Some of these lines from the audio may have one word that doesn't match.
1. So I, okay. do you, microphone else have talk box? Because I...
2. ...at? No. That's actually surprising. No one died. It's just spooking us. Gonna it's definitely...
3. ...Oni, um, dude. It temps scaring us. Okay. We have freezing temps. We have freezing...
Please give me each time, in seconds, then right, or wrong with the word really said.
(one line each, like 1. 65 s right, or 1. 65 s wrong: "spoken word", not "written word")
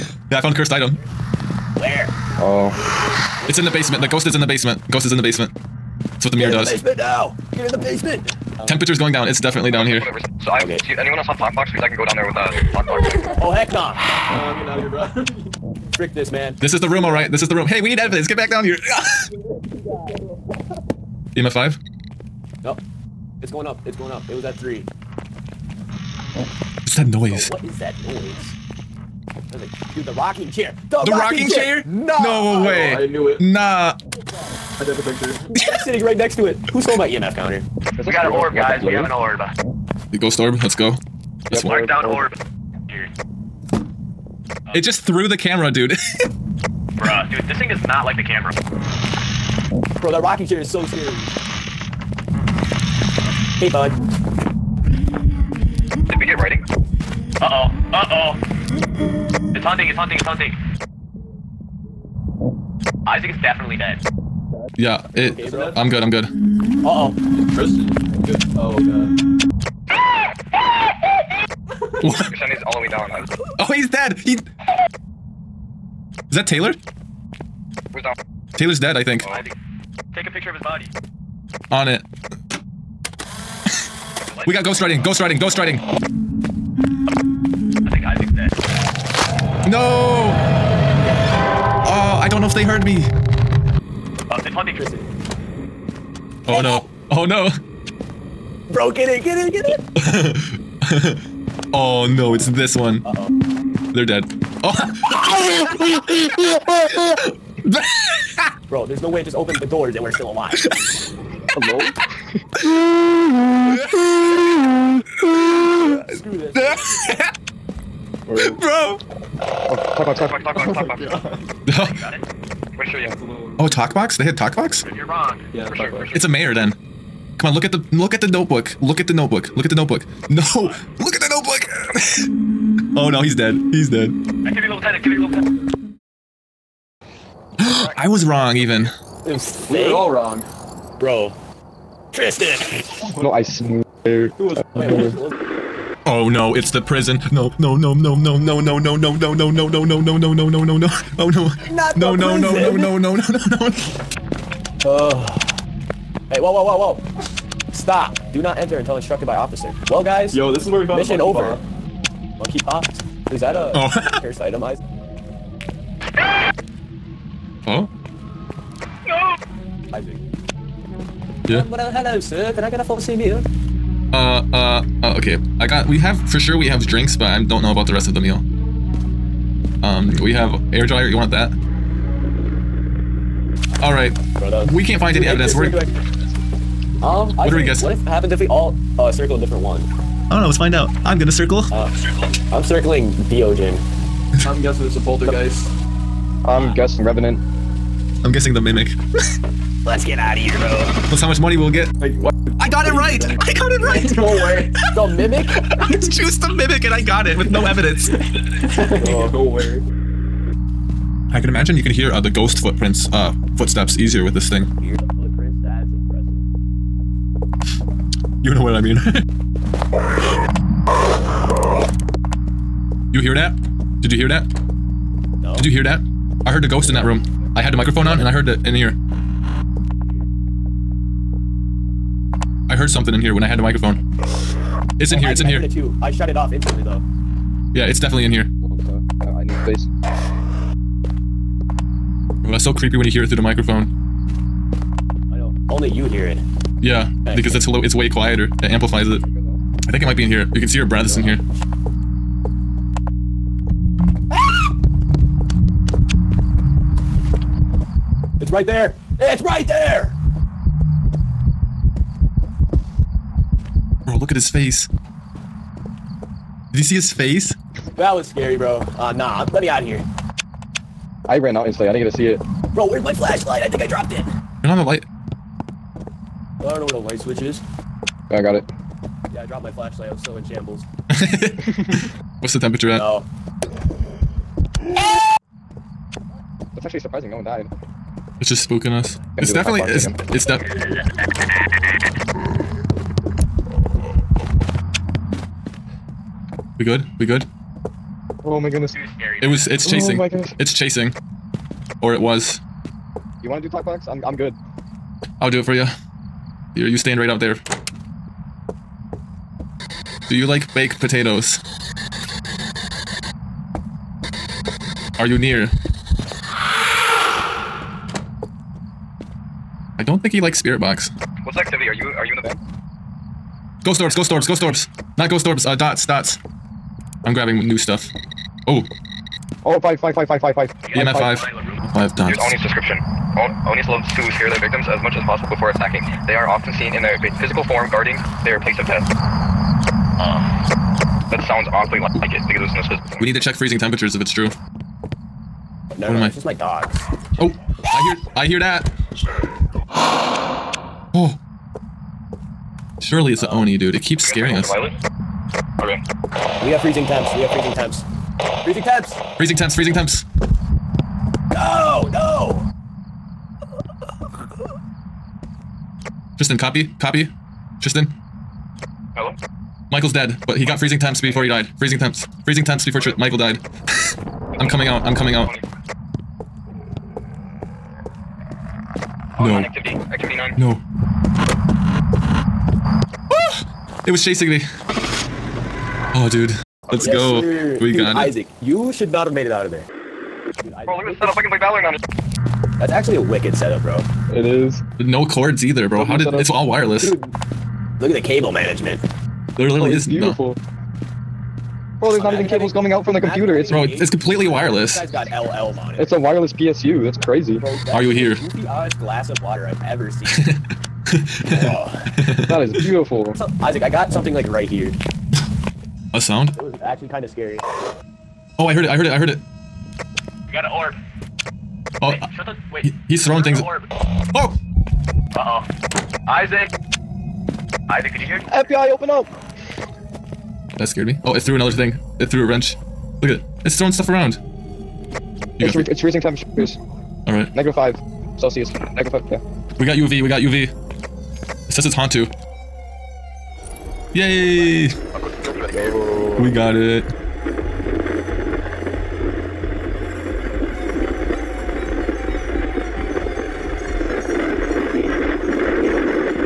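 1. 10 s wrong: "anyone", not "microphone"
2. 282 s right
3. 353 s wrong: "keeps", not "temps".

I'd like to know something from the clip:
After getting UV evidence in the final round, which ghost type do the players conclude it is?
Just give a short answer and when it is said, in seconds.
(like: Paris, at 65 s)
Hantu, at 441 s.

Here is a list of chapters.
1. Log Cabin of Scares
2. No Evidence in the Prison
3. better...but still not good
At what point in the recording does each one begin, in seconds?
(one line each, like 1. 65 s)
1. 209 s
2. 144 s
3. 389 s.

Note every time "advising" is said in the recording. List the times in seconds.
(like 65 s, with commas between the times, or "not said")
not said.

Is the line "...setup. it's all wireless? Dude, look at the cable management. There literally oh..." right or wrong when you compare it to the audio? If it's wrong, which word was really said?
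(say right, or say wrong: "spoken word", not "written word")
right.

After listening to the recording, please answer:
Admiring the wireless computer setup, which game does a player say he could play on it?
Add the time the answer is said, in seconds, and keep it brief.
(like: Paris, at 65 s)
Valorant, at 391 s.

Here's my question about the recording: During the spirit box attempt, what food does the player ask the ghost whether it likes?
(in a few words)
Baked potatoes.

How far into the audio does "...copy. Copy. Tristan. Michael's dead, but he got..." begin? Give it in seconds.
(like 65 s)
366 s.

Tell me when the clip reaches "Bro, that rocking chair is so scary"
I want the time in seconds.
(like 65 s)
49 s.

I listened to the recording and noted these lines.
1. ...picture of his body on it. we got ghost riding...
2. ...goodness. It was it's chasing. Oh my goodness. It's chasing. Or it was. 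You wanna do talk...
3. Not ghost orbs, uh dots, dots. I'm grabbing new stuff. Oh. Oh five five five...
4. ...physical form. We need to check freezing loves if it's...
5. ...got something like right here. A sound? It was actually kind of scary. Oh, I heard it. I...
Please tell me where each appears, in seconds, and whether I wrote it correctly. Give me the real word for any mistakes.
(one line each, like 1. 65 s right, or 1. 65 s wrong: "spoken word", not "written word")
1. 80 s right
2. 298 s right
3. 325 s right
4. 342 s wrong: "temperatures", not "loves"
5. 413 s right.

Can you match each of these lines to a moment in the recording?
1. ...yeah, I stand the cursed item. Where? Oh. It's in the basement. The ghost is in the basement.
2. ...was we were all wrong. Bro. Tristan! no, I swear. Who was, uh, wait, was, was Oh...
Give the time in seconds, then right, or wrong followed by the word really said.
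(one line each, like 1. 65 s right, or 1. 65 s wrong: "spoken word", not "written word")
1. 0 s wrong: "found", not "stand"
2. 139 s right.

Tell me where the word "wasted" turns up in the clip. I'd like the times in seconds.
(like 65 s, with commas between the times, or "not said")
not said.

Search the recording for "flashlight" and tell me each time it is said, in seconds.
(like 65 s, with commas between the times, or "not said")
273 s, 279 s.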